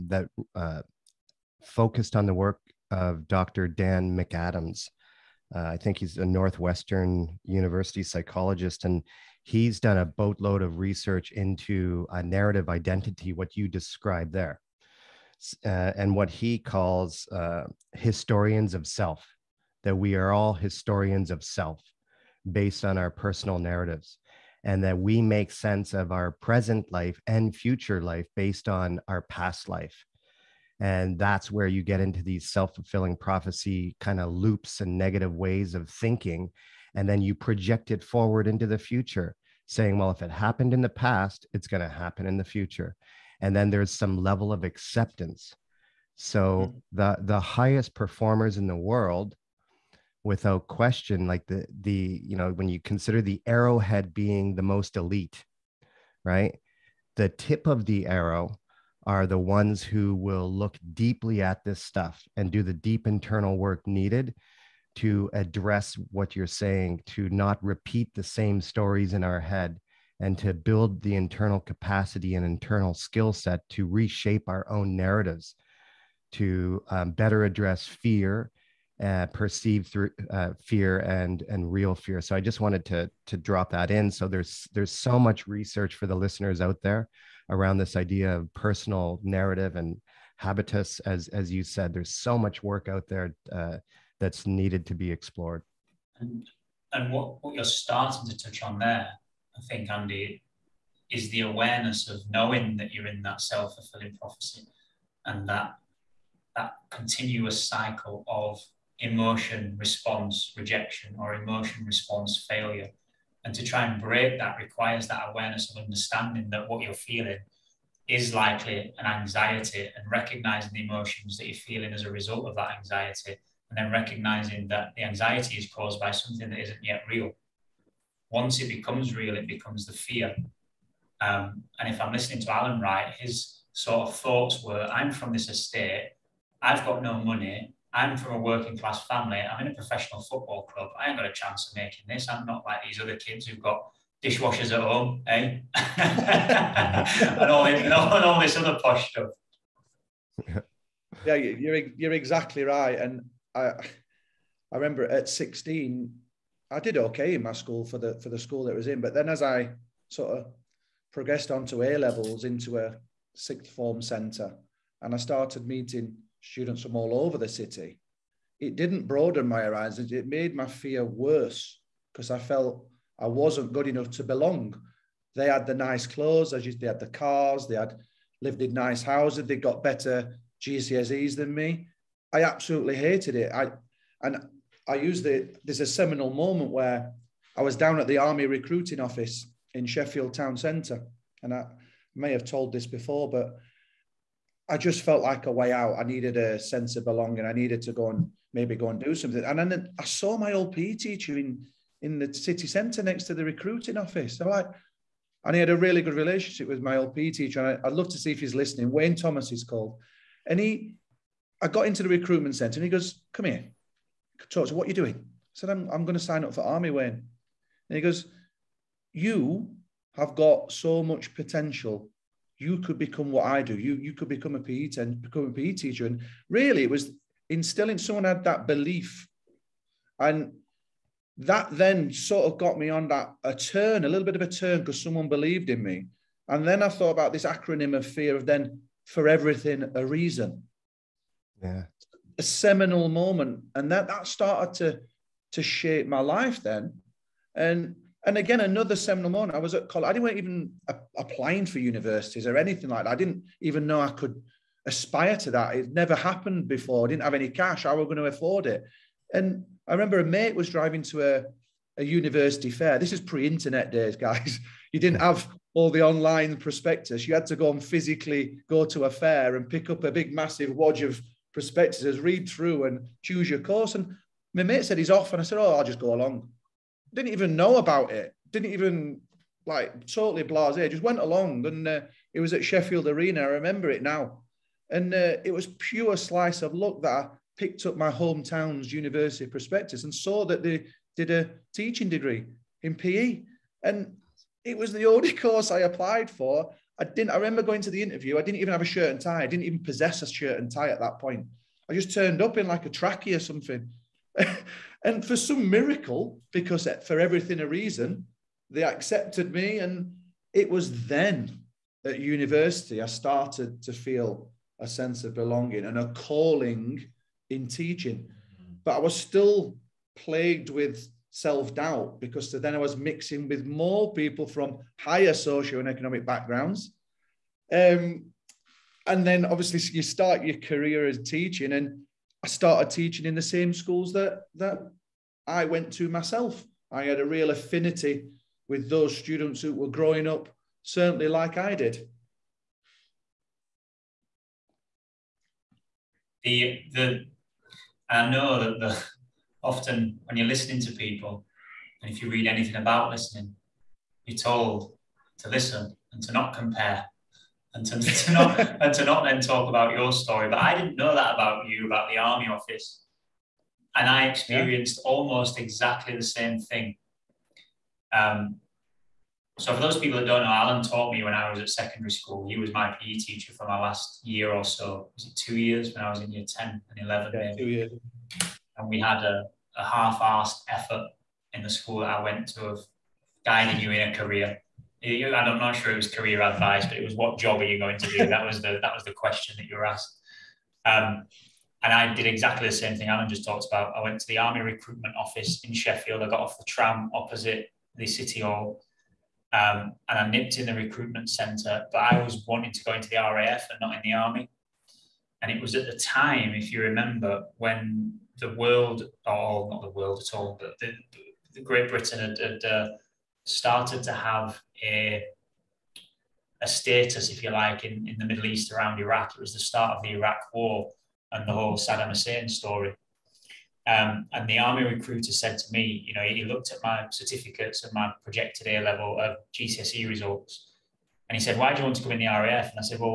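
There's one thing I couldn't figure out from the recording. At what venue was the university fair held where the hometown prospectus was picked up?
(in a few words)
Sheffield Arena.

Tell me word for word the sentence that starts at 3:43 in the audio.
You you could become a PE and become a PE teacher.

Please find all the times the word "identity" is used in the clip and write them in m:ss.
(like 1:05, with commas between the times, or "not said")
0:12.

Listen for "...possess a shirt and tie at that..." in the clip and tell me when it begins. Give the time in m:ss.
4:59.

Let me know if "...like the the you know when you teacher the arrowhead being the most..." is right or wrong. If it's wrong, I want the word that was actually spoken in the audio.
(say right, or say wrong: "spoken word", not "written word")
wrong: "consider", not "teacher".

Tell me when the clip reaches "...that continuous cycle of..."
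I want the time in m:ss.
1:46.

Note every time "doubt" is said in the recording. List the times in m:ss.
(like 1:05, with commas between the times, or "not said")
5:21.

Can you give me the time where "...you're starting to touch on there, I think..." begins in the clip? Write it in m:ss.
1:37.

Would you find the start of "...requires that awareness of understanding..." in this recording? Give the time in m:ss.
1:54.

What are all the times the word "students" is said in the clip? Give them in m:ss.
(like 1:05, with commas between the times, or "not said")
2:46, 5:39.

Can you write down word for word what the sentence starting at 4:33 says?
And my mate said he's off, and I said, "Oh, I'll just go along." didn't even know about it.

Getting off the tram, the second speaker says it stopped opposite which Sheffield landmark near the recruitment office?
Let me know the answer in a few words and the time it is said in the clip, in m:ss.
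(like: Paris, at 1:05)
City Hall, at 6:38.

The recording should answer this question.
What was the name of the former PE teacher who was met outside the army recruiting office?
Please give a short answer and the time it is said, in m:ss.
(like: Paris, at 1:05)
Wayne Thomas, at 3:28.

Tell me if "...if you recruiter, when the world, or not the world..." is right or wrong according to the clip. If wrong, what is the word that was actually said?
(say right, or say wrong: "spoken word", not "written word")
wrong: "remember", not "recruiter".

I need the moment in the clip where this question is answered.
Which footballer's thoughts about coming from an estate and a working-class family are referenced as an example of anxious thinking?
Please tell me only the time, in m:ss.
2:12.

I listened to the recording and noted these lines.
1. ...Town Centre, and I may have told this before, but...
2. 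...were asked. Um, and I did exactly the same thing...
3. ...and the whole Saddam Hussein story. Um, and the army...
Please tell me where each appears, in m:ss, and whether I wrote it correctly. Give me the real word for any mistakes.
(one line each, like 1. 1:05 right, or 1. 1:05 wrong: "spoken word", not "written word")
1. 3:10 right
2. 6:29 right
3. 7:01 right.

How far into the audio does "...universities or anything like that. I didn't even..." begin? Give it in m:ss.
4:11.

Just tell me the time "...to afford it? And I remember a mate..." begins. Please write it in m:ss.
4:18.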